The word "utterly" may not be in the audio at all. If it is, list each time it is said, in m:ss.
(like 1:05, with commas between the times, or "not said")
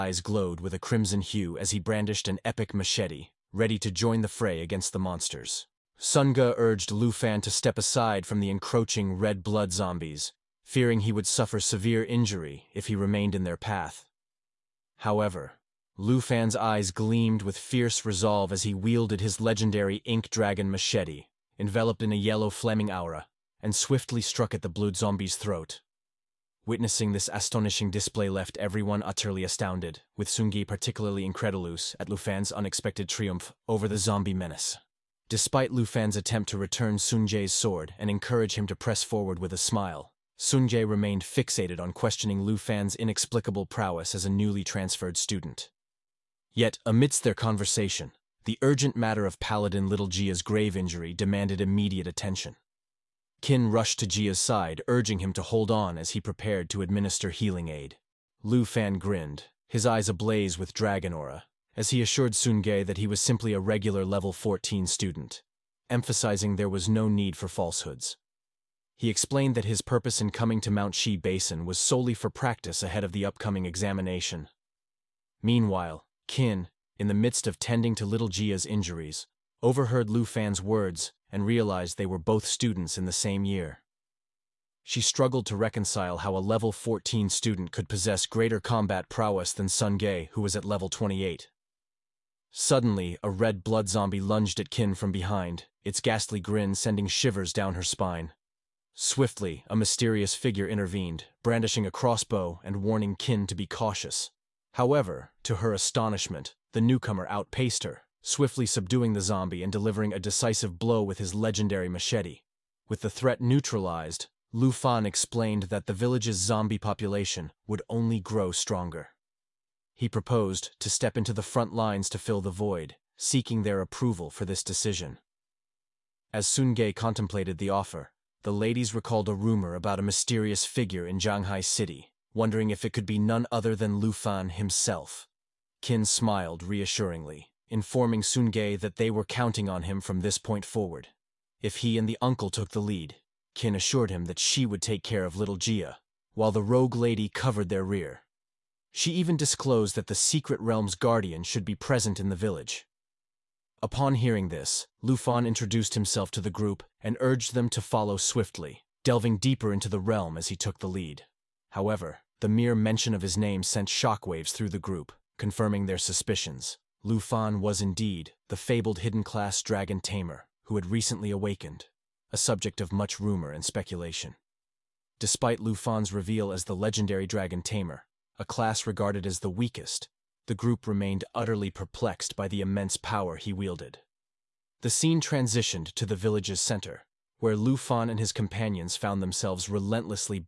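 0:29, 3:01.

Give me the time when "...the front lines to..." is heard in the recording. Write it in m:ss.
2:01.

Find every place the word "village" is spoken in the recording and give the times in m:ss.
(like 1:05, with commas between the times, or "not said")
1:55, 2:32, 3:06.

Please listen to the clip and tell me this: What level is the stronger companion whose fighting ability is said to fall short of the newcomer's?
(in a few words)
28.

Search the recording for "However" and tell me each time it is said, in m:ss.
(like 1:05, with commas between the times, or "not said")
0:14, 1:44, 2:41.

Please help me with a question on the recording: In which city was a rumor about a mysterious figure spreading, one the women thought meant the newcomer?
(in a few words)
Jianghai City.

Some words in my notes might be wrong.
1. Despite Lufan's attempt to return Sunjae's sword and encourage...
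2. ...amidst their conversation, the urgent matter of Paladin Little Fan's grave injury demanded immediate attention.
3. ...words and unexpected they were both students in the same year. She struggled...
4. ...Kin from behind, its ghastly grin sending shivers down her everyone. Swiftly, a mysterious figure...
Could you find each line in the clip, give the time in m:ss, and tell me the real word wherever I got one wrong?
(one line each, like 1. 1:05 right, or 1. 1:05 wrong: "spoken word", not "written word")
1. 0:35 right
2. 0:46 wrong: "Gia", not "Fan"
3. 1:20 wrong: "realized", not "unexpected"
4. 1:34 wrong: "spine", not "everyone".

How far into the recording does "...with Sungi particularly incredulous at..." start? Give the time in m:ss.
0:30.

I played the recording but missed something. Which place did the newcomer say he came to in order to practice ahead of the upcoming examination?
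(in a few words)
Mount Shi Basin.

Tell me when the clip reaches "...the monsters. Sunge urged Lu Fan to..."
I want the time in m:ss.
0:04.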